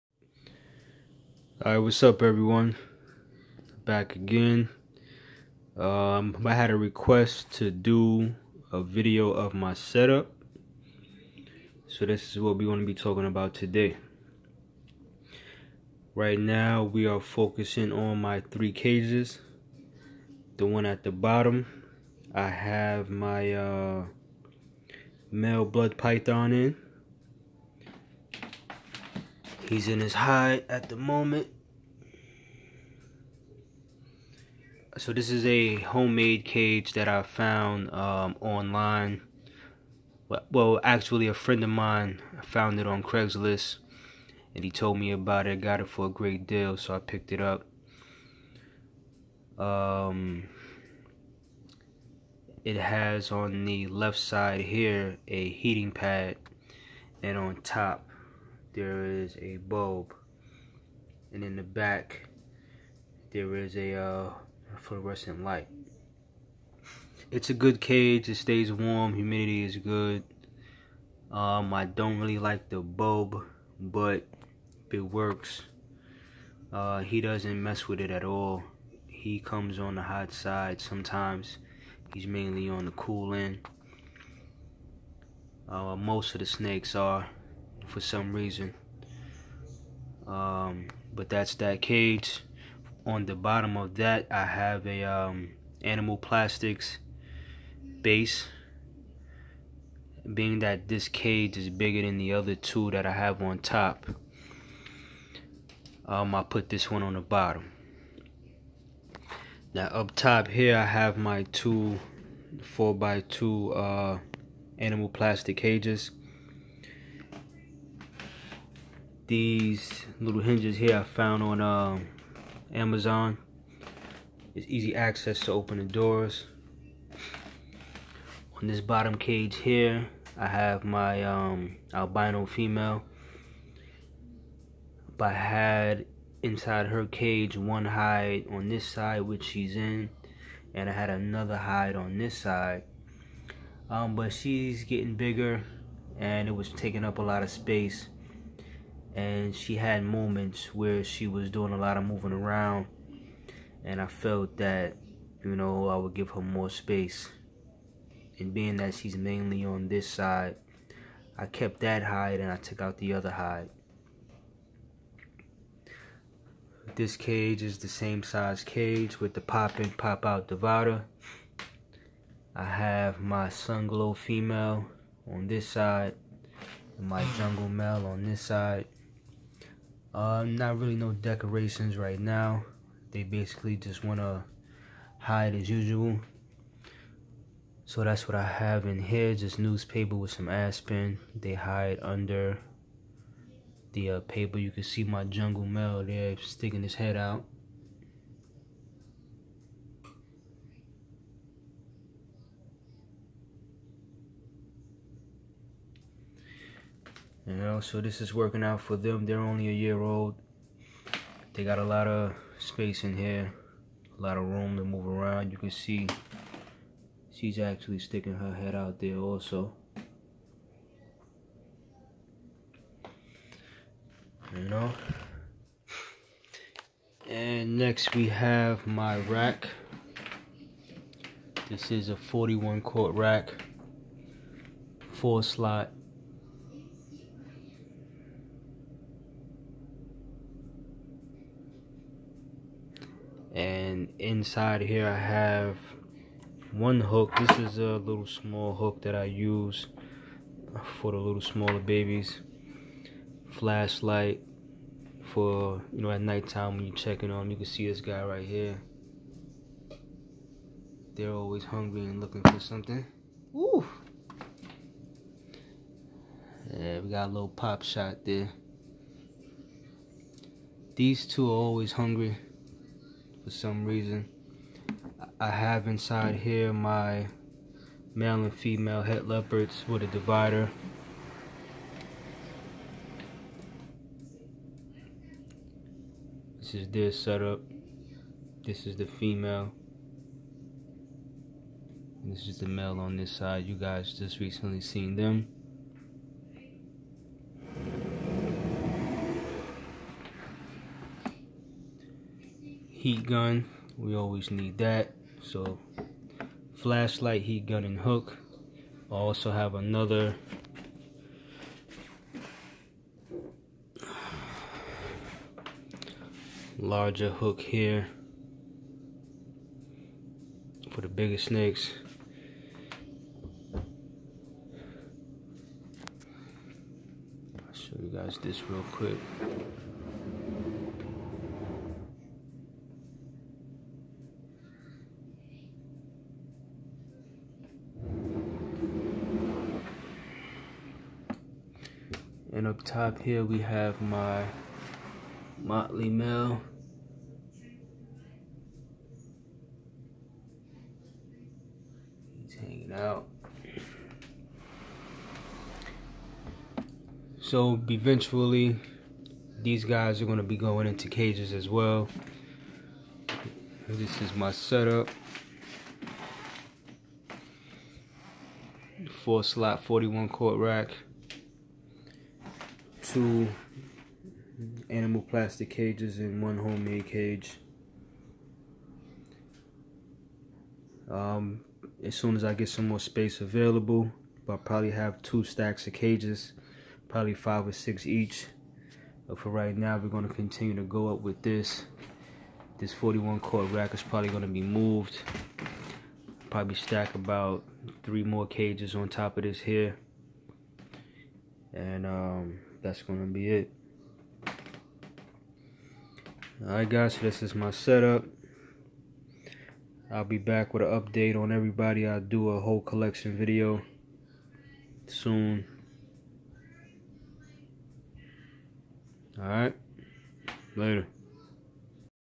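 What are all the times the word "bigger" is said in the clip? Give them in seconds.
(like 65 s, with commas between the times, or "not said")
101 s, 145 s, 321 s.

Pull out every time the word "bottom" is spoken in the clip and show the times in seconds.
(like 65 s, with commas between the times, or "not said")
21 s, 93 s, 107 s, 128 s.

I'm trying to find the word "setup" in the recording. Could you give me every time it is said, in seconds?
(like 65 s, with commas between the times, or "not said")
9 s, 287 s, 364 s, 407 s.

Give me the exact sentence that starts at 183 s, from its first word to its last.
They basically just want to hide as usual.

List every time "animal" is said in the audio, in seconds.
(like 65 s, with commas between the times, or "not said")
95 s, 114 s, 374 s.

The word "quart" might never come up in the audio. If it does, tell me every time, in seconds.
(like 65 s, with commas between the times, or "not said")
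232 s, 370 s, 393 s.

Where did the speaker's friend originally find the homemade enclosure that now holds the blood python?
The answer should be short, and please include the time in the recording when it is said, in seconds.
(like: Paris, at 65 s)
Craigslist, at 43 s.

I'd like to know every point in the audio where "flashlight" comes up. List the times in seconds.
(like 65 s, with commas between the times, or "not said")
253 s, 306 s.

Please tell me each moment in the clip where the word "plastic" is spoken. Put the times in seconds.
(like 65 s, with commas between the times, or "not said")
96 s, 115 s, 375 s.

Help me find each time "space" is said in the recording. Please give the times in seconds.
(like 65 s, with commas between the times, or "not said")
147 s, 156 s, 212 s, 383 s.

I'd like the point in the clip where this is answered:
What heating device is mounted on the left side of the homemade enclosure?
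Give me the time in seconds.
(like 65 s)
55 s.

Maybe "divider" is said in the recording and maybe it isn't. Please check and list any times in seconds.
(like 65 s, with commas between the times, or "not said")
170 s, 280 s.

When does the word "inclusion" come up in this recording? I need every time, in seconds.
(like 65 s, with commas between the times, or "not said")
not said.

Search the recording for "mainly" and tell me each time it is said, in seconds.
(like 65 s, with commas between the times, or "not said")
82 s, 159 s.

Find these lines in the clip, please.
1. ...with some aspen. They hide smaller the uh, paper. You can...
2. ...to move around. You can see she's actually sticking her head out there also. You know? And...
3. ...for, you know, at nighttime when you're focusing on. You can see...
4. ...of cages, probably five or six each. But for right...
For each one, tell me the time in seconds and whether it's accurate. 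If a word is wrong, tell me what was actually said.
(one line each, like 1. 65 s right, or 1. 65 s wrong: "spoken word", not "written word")
1. 190 s wrong: "under", not "smaller"
2. 214 s right
3. 255 s wrong: "checking", not "focusing"
4. 385 s right.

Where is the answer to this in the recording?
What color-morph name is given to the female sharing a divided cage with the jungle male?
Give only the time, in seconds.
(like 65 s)
173 s.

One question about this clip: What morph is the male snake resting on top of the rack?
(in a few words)
Motley.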